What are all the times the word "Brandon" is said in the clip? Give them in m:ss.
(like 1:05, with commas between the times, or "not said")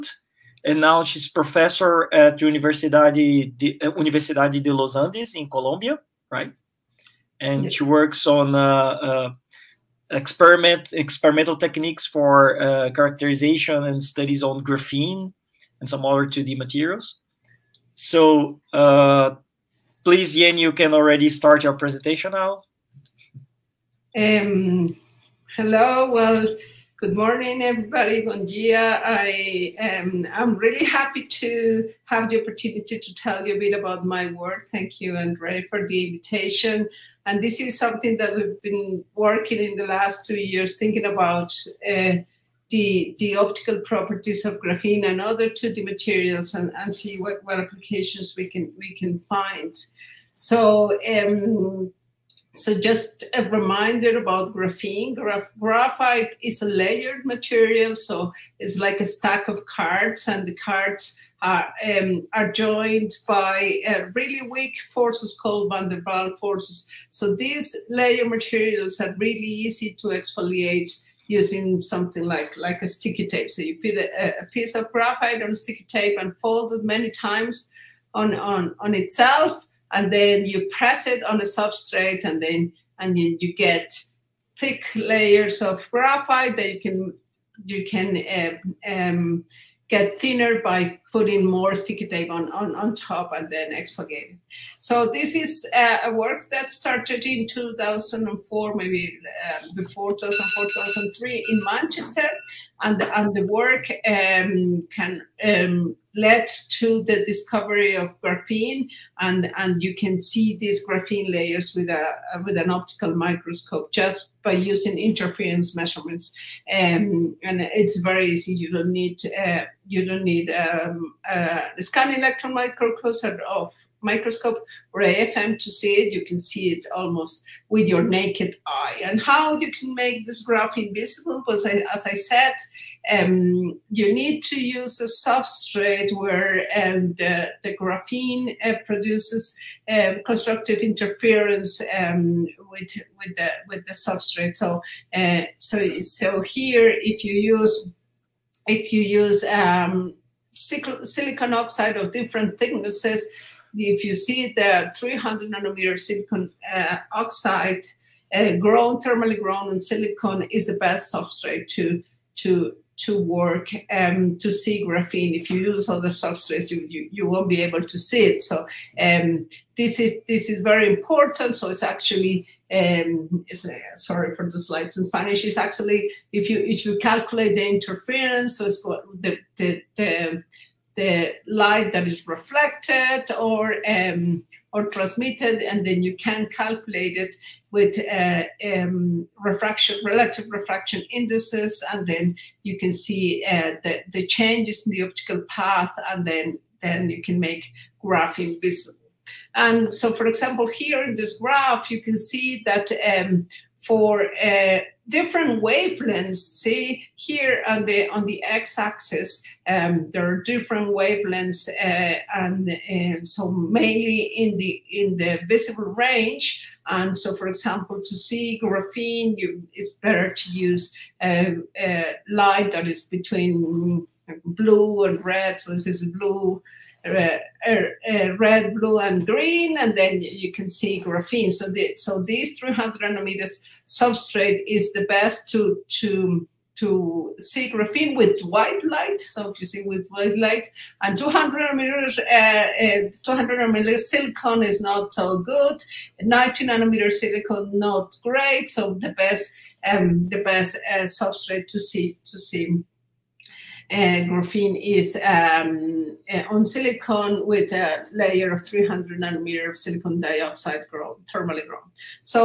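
not said.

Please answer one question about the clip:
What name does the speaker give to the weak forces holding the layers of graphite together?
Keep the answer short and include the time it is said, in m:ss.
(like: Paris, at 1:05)
van der Waal forces, at 1:05.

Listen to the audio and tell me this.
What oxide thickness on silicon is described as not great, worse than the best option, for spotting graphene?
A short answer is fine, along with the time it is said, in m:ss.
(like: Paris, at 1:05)
90 nanometers, at 4:06.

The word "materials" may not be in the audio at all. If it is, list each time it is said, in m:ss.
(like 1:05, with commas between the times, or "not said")
0:16, 0:45, 0:57, 1:08.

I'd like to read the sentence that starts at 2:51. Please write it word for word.
So it's actually um, it's, uh, sorry for the slides in Spanish.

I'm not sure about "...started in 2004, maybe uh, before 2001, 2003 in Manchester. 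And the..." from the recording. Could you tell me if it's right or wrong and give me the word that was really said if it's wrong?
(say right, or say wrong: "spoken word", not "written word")
wrong: "2004", not "2001".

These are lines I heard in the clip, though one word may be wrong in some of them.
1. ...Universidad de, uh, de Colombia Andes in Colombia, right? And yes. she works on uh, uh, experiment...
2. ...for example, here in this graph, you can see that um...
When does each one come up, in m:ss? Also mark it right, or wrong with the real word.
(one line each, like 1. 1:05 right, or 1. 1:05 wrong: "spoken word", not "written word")
1. 0:02 wrong: "Los", not "Colombia"
2. 3:20 right.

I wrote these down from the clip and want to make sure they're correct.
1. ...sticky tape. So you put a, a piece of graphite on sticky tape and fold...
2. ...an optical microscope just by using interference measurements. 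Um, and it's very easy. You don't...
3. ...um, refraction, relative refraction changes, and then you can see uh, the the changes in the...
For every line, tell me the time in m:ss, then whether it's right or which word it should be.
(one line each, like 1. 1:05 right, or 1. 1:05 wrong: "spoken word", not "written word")
1. 1:12 right
2. 1:52 right
3. 3:08 wrong: "indices", not "changes".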